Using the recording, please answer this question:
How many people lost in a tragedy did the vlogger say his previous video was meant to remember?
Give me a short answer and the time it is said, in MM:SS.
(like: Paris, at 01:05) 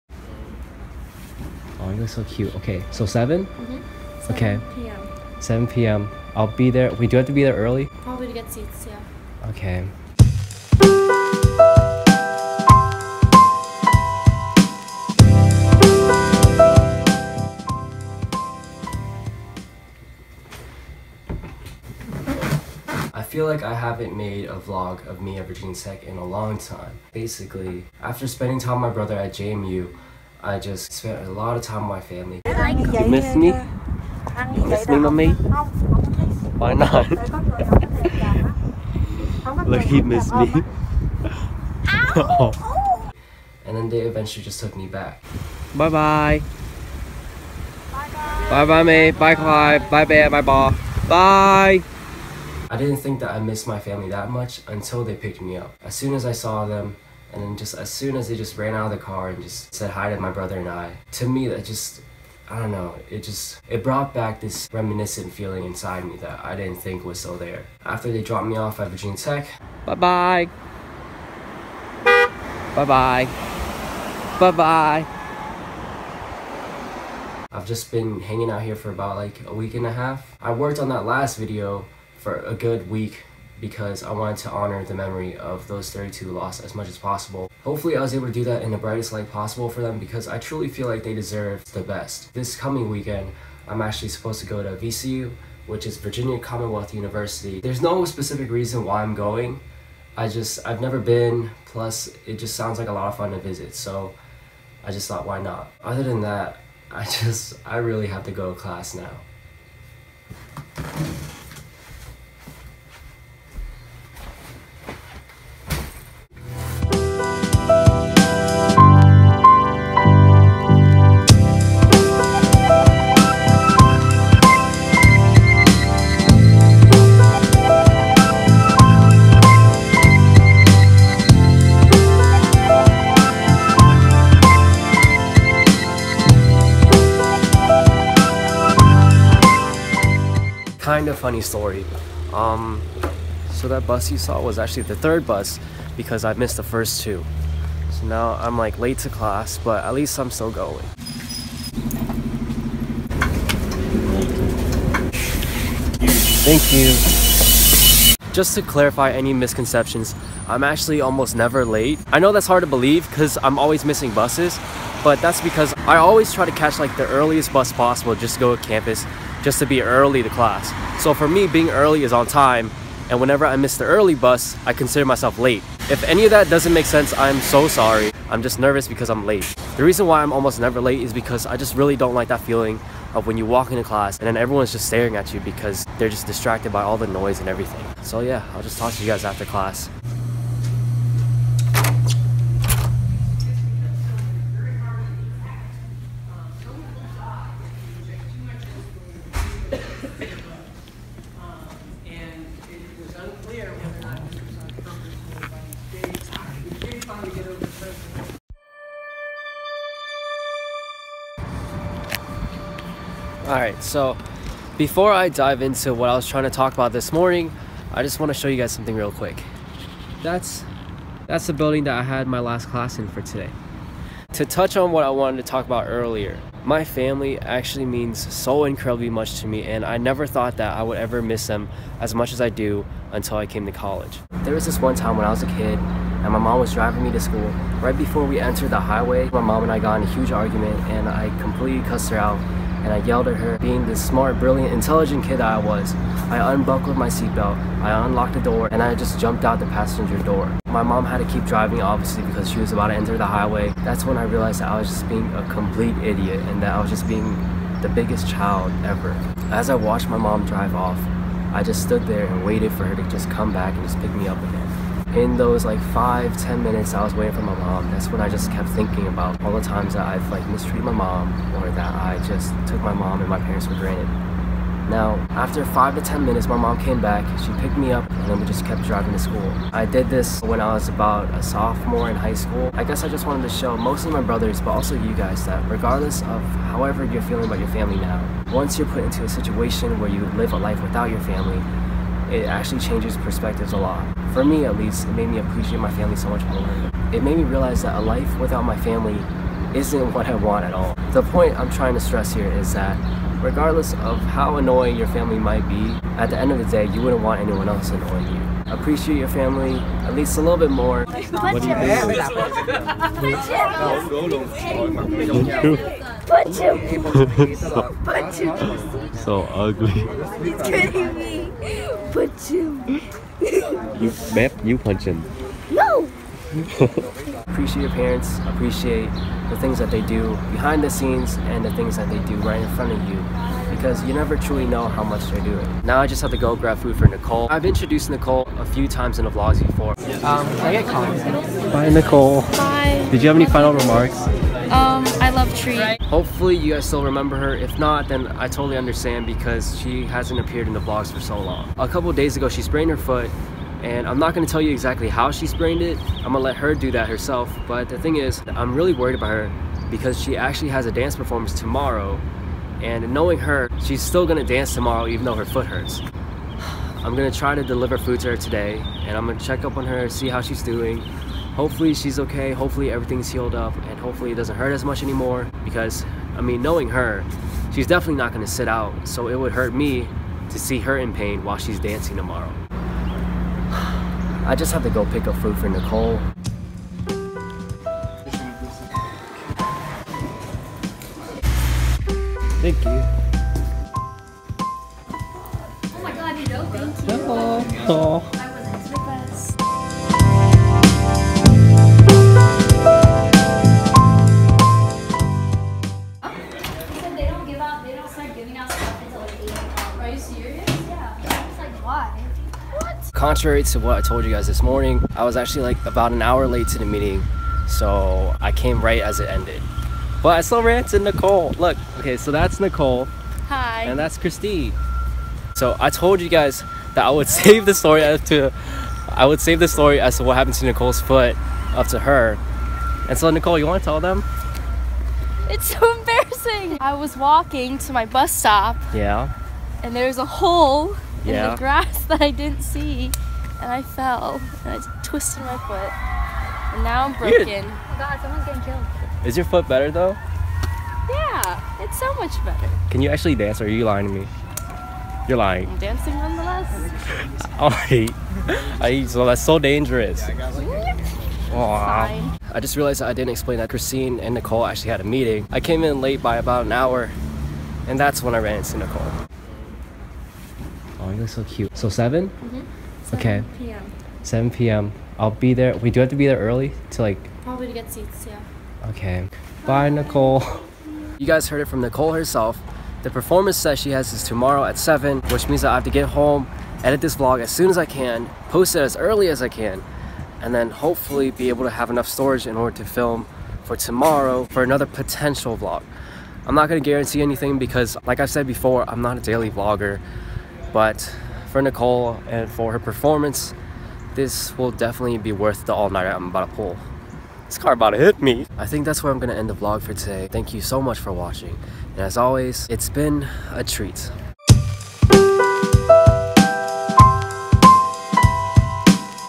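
32, at 01:25.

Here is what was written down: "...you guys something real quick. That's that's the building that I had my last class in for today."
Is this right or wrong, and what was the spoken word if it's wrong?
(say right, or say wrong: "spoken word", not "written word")
right.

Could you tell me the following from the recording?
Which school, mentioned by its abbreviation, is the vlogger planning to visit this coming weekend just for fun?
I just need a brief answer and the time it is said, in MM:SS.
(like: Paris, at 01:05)
VCU, at 01:34.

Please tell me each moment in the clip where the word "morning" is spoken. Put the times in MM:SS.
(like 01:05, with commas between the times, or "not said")
03:37, 06:54.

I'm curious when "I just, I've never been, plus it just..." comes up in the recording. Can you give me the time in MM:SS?
01:40.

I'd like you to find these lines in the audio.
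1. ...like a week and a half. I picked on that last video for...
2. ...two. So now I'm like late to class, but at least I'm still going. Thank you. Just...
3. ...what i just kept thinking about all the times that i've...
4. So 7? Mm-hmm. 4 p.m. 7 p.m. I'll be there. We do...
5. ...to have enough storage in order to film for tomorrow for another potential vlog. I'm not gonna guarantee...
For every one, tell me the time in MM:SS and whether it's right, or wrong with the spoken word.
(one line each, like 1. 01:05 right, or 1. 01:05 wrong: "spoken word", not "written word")
1. 01:19 wrong: "worked", not "picked"
2. 02:27 right
3. 04:28 right
4. 07:51 wrong: "7", not "4"
5. 08:11 right.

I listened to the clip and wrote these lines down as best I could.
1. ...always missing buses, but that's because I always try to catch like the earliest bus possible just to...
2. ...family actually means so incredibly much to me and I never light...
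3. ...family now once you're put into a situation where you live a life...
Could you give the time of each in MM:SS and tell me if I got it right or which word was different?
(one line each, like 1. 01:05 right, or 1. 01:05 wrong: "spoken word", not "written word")
1. 02:43 right
2. 03:46 wrong: "thought", not "light"
3. 04:47 right.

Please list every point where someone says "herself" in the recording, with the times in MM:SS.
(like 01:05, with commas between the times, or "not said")
05:57, 08:02.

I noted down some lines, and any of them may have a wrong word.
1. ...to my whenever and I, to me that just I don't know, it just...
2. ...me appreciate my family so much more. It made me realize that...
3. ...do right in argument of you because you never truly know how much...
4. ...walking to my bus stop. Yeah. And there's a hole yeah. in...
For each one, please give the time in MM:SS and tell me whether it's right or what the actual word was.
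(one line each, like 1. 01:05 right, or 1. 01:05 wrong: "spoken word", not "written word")
1. 01:00 wrong: "brother", not "whenever"
2. 04:55 right
3. 05:32 wrong: "front", not "argument"
4. 07:17 right.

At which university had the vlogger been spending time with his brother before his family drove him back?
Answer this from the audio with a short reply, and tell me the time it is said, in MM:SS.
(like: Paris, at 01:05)
JMU, at 00:29.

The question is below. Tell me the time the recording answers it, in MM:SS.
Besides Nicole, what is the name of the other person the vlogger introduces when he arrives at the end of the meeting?
07:04.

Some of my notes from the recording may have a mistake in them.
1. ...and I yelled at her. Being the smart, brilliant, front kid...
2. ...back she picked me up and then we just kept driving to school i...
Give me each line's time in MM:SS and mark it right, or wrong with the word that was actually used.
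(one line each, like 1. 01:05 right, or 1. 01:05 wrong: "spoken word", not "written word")
1. 04:02 wrong: "intelligent", not "front"
2. 04:37 right.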